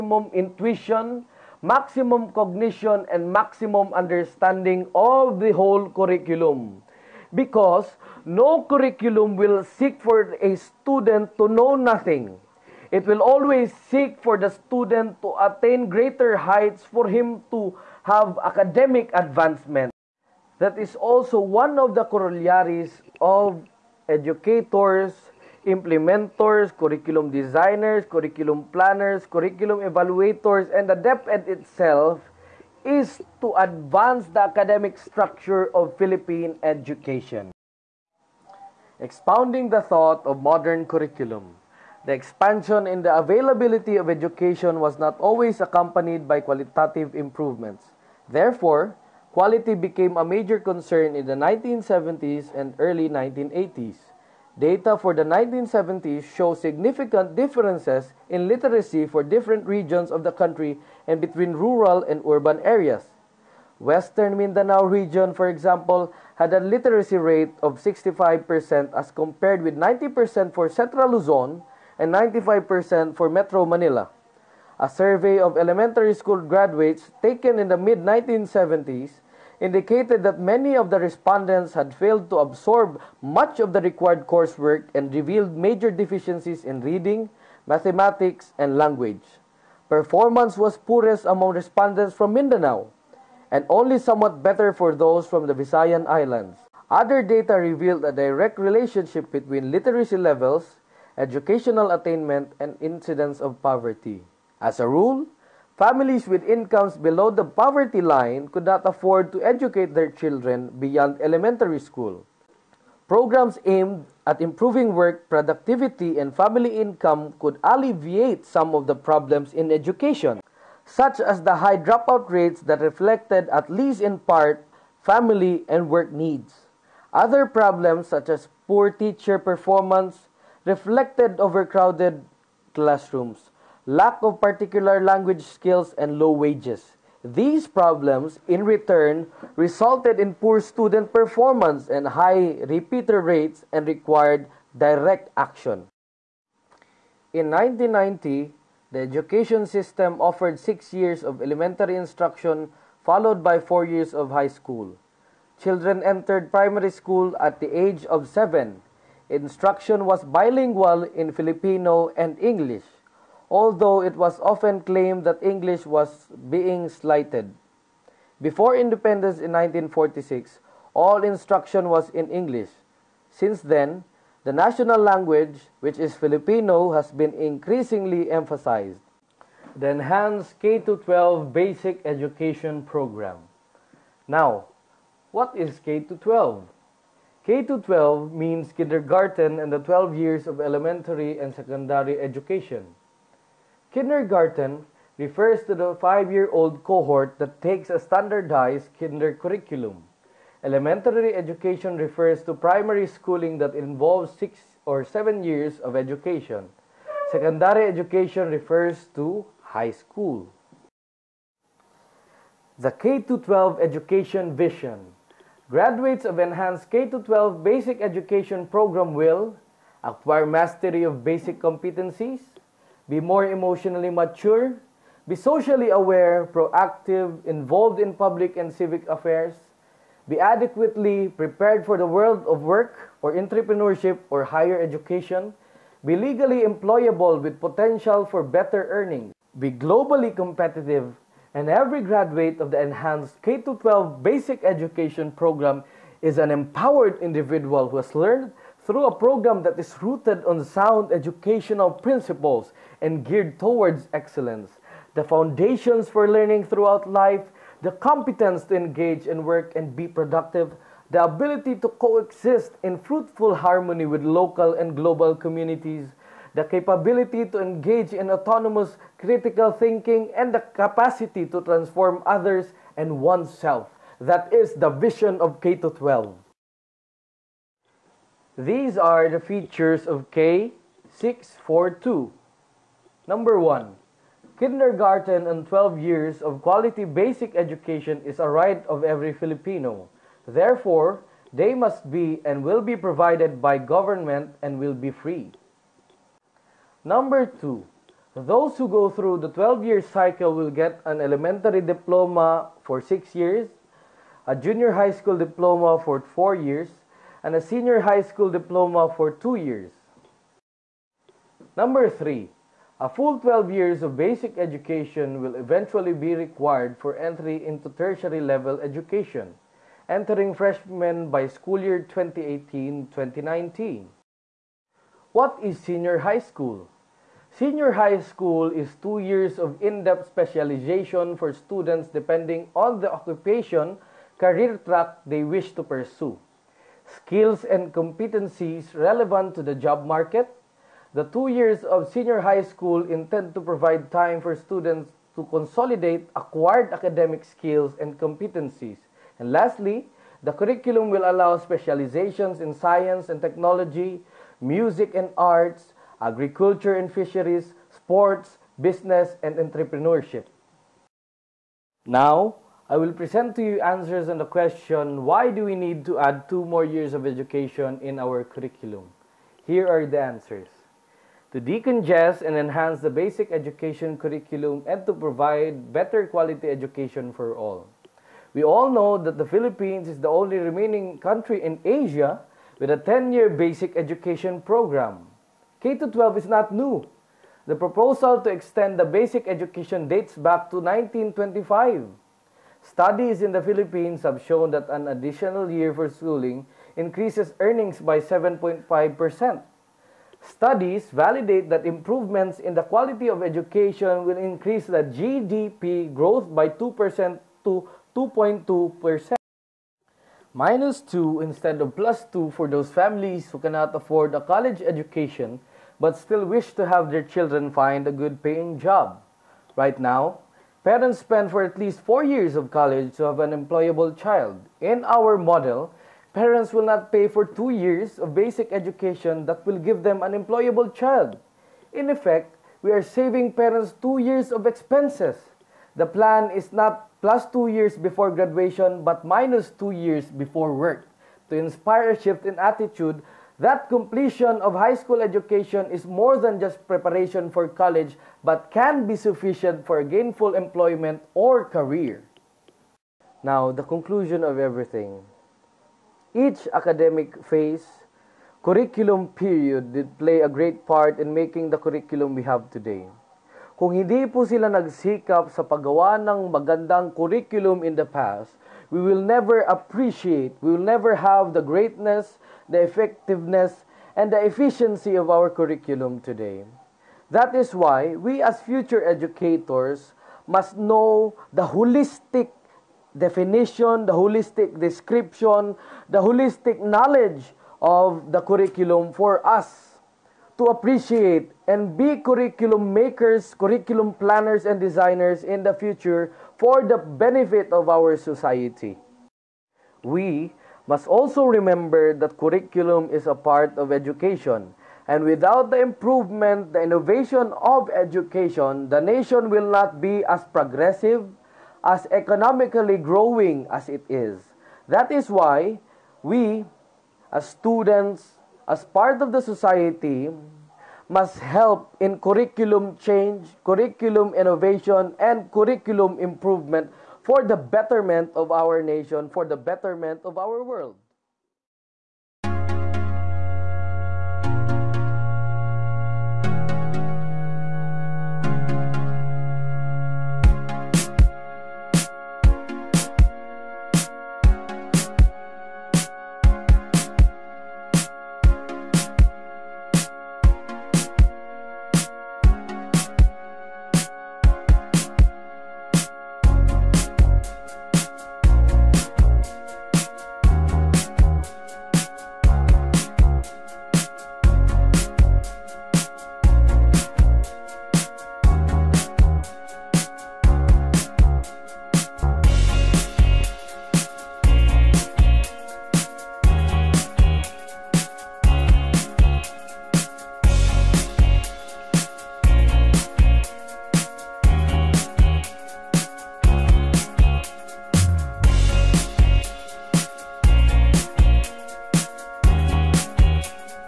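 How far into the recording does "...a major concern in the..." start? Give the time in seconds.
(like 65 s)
50 s.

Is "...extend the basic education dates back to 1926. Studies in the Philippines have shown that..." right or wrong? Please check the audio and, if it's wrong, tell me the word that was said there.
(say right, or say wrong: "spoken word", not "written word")
wrong: "1925", not "1926".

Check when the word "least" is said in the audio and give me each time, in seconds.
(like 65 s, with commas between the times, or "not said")
123 s, 421 s.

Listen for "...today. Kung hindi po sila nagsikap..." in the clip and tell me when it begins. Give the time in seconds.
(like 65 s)
462 s.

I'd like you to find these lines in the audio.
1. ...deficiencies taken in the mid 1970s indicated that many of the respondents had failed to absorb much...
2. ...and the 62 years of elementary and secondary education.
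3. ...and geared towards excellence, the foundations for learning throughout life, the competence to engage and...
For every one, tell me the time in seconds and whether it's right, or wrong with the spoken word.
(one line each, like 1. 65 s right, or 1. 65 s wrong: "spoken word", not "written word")
1. 76 s wrong: "graduates", not "deficiencies"
2. 189 s wrong: "12", not "62"
3. 253 s right.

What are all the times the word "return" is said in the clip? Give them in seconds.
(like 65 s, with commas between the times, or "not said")
138 s.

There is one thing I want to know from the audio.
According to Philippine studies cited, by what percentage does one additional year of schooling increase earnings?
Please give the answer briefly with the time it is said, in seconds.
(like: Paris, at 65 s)
7.5 percent, at 398 s.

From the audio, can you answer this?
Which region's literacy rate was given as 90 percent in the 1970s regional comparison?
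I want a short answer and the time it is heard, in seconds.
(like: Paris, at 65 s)
Central Luzon, at 70 s.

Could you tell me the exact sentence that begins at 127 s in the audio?
Other problems, such as poor teacher performance, reflected overcrowded classrooms lack of particular language skills, and low wages.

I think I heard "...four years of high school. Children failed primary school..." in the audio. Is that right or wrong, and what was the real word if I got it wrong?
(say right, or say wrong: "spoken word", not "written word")
wrong: "entered", not "failed".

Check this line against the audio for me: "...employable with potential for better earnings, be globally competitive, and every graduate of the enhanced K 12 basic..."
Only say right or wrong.
right.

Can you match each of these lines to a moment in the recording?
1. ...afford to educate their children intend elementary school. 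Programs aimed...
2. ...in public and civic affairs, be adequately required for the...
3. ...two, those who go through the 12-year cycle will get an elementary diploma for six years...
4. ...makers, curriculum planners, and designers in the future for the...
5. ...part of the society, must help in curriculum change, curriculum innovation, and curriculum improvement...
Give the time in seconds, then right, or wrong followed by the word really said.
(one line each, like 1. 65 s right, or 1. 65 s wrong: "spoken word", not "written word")
1. 108 s wrong: "beyond", not "intend"
2. 227 s wrong: "prepared", not "required"
3. 297 s right
4. 492 s right
5. 518 s right.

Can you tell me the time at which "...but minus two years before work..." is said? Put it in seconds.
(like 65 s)
439 s.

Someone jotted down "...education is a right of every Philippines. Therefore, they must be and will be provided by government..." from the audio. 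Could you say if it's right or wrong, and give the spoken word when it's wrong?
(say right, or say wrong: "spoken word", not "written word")
wrong: "Filipino", not "Philippines".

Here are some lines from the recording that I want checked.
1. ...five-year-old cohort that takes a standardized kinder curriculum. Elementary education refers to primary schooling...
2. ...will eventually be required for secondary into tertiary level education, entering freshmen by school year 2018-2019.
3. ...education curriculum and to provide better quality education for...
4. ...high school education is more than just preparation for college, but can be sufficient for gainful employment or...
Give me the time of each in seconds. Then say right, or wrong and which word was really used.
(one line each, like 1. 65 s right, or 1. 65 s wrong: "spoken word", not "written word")
1. 195 s right
2. 315 s wrong: "entry", not "secondary"
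3. 373 s right
4. 444 s right.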